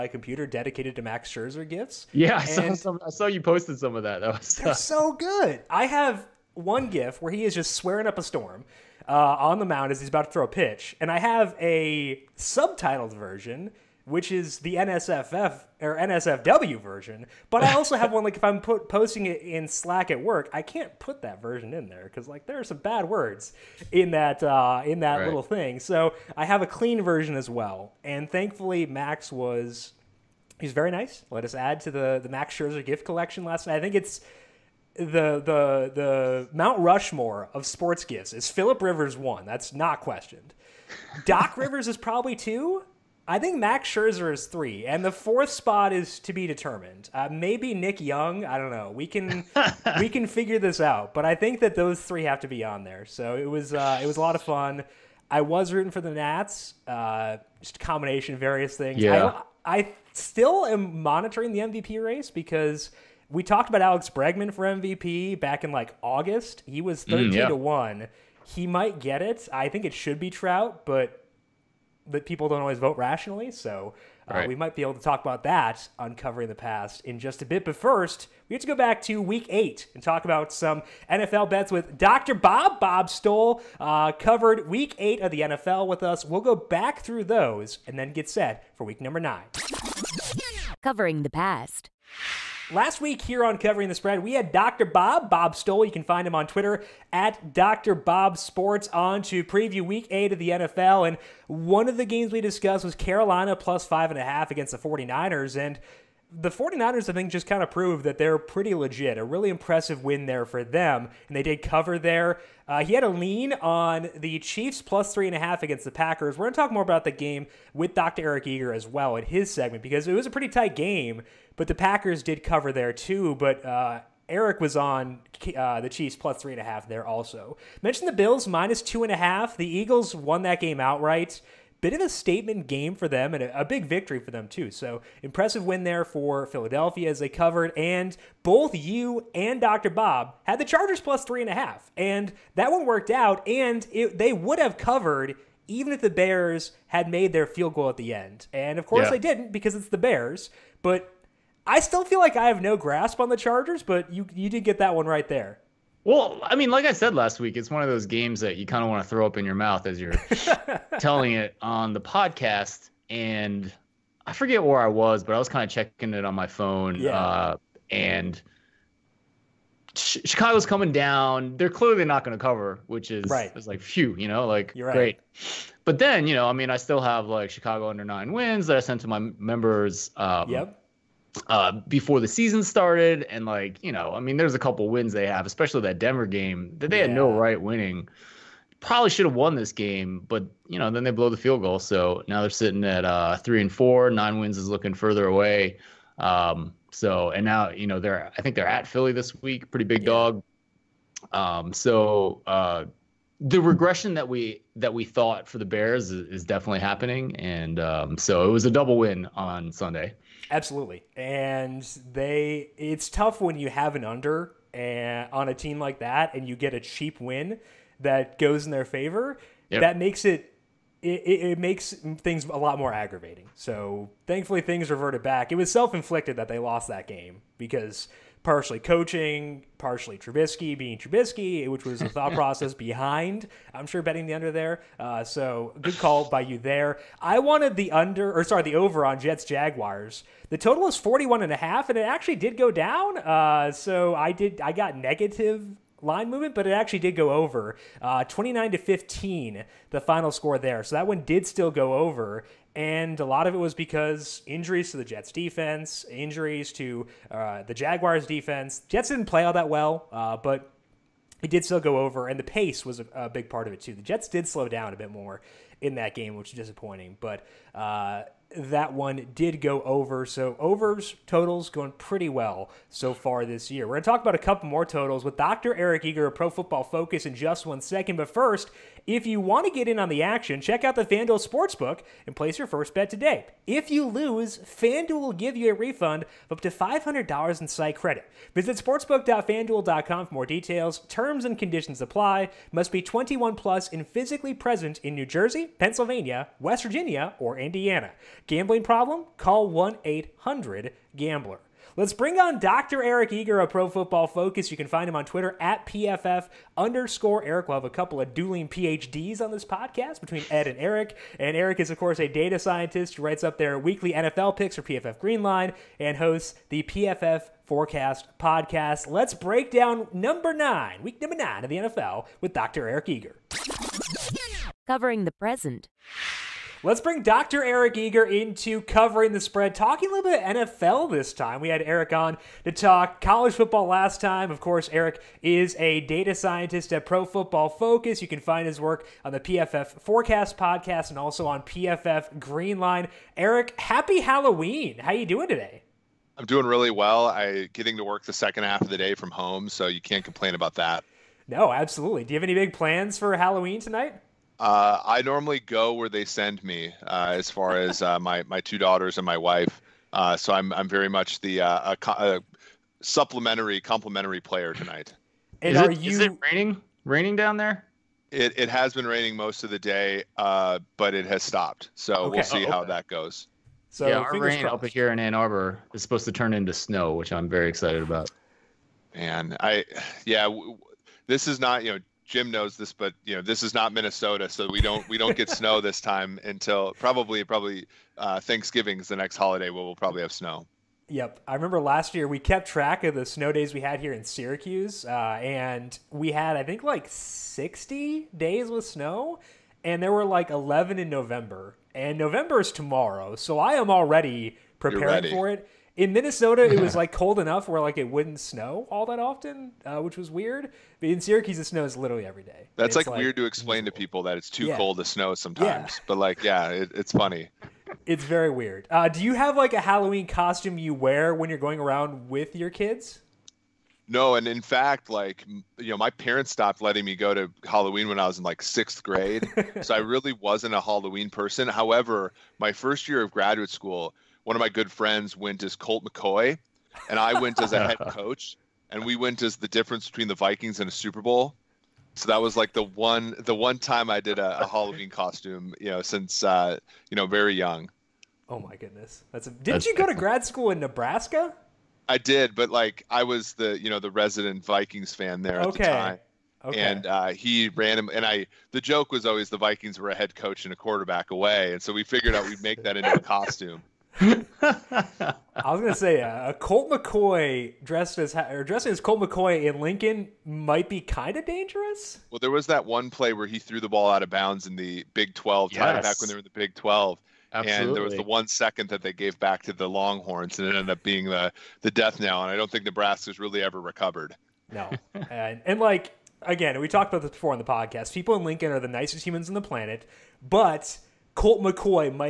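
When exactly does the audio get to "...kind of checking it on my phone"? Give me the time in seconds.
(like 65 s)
165 s.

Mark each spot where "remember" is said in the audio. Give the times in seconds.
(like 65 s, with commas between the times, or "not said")
391 s.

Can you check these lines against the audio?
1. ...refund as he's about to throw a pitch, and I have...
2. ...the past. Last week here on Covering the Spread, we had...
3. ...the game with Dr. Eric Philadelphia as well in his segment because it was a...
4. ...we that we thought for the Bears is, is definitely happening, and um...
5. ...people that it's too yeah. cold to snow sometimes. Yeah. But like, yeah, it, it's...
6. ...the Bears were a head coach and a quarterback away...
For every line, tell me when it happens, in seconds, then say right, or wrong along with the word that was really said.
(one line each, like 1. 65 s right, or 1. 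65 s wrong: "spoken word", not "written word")
1. 9 s wrong: "mound", not "refund"
2. 91 s right
3. 117 s wrong: "Eager", not "Philadelphia"
4. 204 s right
5. 413 s right
6. 459 s wrong: "Vikings", not "Bears".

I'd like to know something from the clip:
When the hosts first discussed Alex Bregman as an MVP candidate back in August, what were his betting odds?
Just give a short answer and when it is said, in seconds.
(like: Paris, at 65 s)
13 to 1, at 67 s.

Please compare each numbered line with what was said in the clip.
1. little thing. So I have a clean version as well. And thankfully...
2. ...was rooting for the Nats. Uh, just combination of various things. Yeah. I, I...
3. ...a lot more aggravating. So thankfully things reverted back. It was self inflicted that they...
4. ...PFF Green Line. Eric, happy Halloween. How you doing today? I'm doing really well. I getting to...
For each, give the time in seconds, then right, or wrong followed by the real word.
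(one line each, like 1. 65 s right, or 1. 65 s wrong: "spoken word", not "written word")
1. 25 s right
2. 55 s right
3. 222 s right
4. 341 s right.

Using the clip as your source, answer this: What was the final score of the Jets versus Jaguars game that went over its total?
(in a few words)
29 to 15.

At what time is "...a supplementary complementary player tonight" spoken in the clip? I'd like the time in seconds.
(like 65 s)
362 s.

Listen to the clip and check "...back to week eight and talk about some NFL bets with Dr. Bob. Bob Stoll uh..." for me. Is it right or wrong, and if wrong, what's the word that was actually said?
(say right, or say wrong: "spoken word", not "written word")
right.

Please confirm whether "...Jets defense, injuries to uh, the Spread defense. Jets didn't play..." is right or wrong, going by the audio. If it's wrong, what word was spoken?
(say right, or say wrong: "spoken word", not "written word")
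wrong: "Jaguars", not "Spread".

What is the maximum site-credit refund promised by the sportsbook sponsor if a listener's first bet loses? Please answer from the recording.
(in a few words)
$500.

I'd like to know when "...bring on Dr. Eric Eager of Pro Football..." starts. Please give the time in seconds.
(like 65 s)
302 s.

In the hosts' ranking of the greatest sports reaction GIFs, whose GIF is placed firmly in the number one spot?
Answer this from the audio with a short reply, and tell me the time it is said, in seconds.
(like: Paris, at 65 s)
Philip Rivers, at 38 s.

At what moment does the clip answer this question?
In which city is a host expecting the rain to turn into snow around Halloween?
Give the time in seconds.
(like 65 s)
375 s.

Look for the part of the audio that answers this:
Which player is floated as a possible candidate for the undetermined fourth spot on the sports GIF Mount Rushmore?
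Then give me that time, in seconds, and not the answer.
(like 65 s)
47 s.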